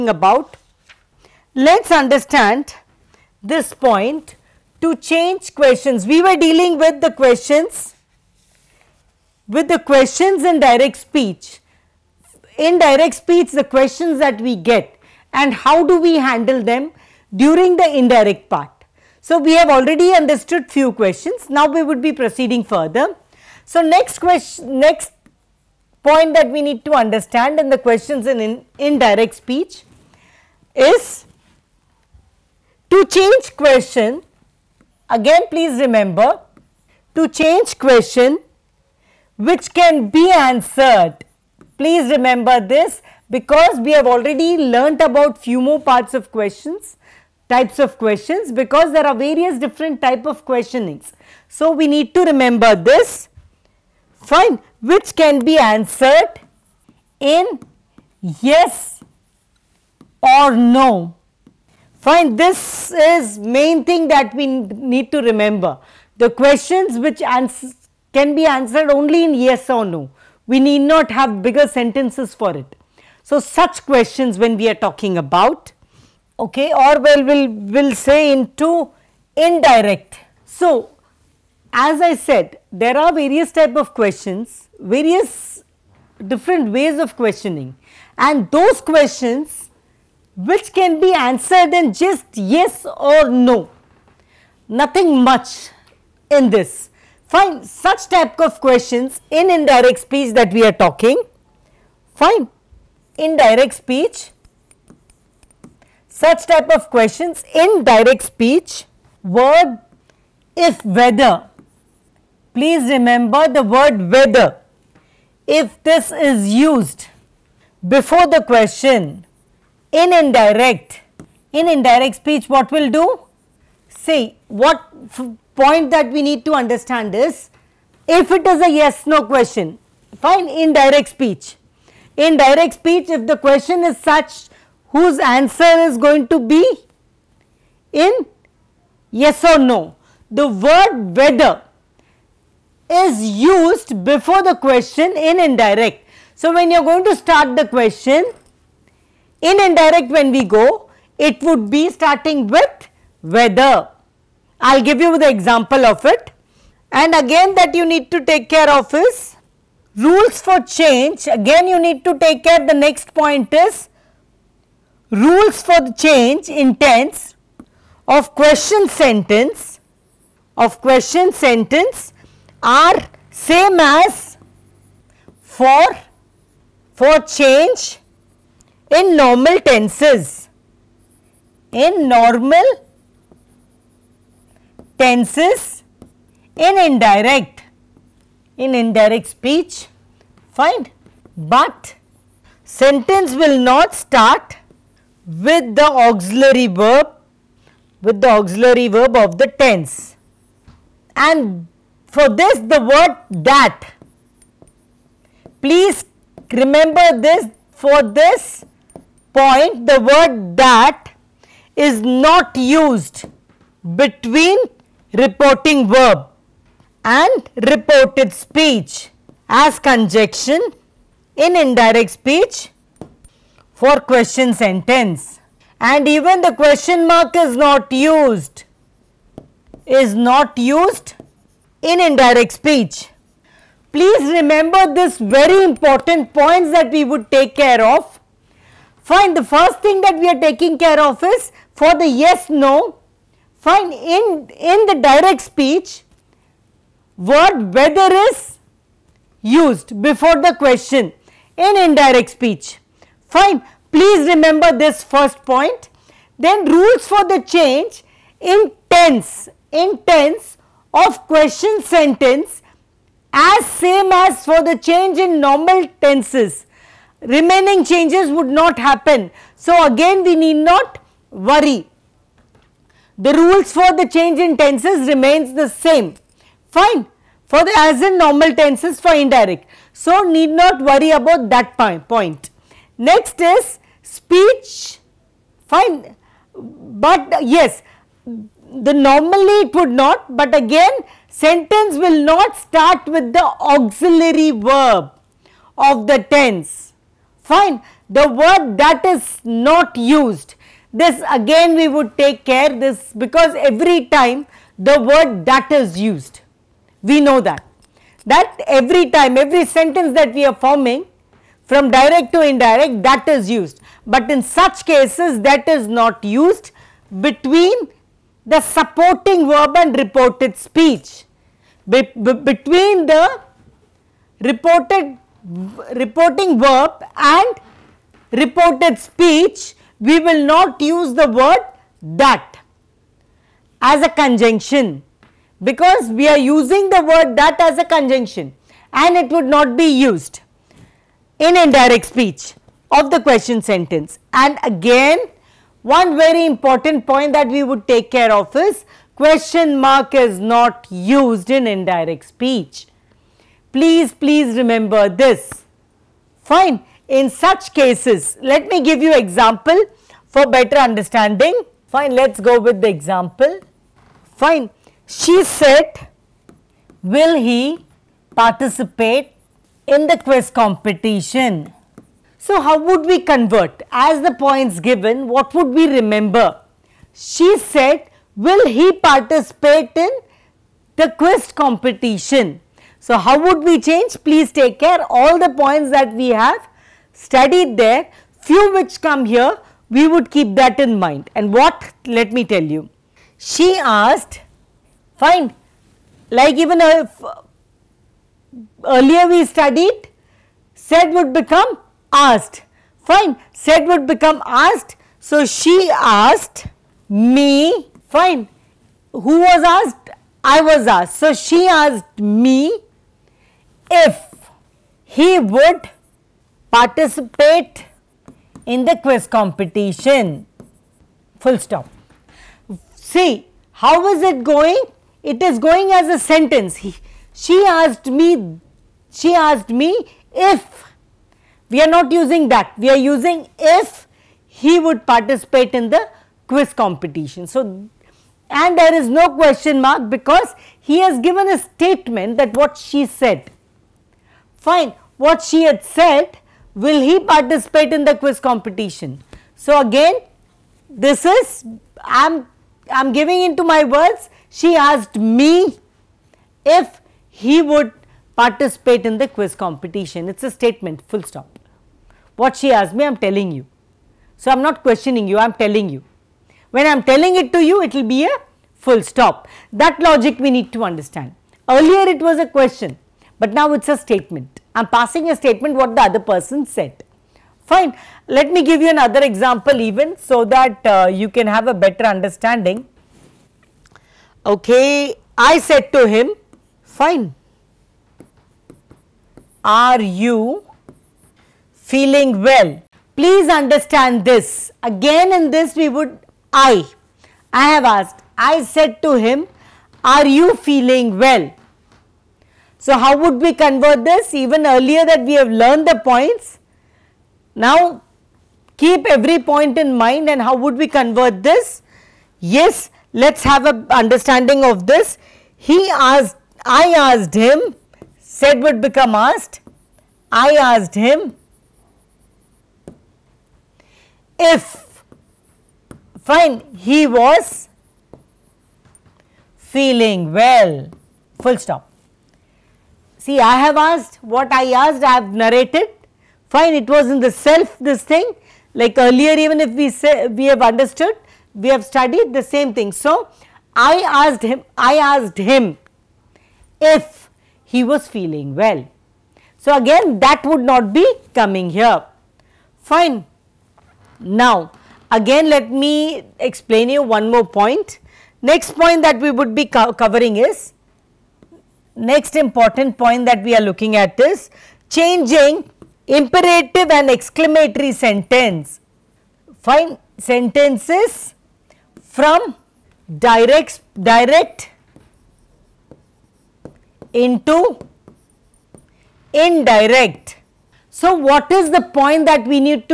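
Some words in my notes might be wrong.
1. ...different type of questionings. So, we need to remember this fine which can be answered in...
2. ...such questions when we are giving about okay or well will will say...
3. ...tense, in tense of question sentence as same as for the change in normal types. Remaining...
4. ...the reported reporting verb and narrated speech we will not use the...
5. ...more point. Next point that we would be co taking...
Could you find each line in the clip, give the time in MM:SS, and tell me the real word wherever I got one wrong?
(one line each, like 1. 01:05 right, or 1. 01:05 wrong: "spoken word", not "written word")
1. 00:49 right
2. 01:13 wrong: "talking", not "giving"
3. 04:18 wrong: "tenses", not "types"
4. 05:23 wrong: "reported", not "narrated"
5. 09:17 wrong: "covering", not "taking".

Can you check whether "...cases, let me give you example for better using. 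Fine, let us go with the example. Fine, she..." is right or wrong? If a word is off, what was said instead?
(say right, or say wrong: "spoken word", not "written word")
wrong: "understanding", not "using".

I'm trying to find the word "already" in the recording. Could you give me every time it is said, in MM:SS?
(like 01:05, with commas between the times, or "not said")
00:19, 00:44.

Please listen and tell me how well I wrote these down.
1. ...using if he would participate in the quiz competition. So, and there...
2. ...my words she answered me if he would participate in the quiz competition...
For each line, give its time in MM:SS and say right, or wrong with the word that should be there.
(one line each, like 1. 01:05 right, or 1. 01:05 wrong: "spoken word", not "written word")
1. 07:13 right
2. 07:33 wrong: "asked", not "answered".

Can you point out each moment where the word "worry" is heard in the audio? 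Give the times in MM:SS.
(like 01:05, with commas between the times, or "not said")
04:31, 04:40.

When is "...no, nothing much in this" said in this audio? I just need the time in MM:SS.
01:33.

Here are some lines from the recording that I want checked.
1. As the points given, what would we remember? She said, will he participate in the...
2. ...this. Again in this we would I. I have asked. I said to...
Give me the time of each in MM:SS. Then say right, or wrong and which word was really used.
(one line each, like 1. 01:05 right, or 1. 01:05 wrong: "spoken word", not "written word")
1. 06:13 right
2. 08:14 right.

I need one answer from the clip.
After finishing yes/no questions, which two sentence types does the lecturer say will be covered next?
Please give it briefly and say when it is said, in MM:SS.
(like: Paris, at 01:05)
imperative and exclamatory, at 09:26.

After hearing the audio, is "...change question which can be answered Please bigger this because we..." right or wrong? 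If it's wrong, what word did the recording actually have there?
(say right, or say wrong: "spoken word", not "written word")
wrong: "remember", not "bigger".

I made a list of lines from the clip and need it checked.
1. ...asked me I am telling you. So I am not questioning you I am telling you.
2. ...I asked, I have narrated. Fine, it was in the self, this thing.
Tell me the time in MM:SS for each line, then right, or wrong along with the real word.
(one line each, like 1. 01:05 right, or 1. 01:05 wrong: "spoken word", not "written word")
1. 07:42 right
2. 08:54 right.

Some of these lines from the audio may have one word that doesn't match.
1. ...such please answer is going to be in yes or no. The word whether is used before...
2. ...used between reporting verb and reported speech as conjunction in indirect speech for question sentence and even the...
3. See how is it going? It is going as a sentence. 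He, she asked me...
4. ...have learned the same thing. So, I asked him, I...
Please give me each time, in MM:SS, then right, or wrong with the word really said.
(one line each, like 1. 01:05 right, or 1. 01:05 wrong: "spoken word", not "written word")
1. 02:13 wrong: "whose", not "please"
2. 03:32 right
3. 07:02 right
4. 09:01 wrong: "studied", not "learned".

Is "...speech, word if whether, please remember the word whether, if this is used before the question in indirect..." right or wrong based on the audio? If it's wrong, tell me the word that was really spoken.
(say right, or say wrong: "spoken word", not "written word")
right.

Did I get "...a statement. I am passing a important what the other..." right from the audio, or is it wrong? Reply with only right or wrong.
wrong.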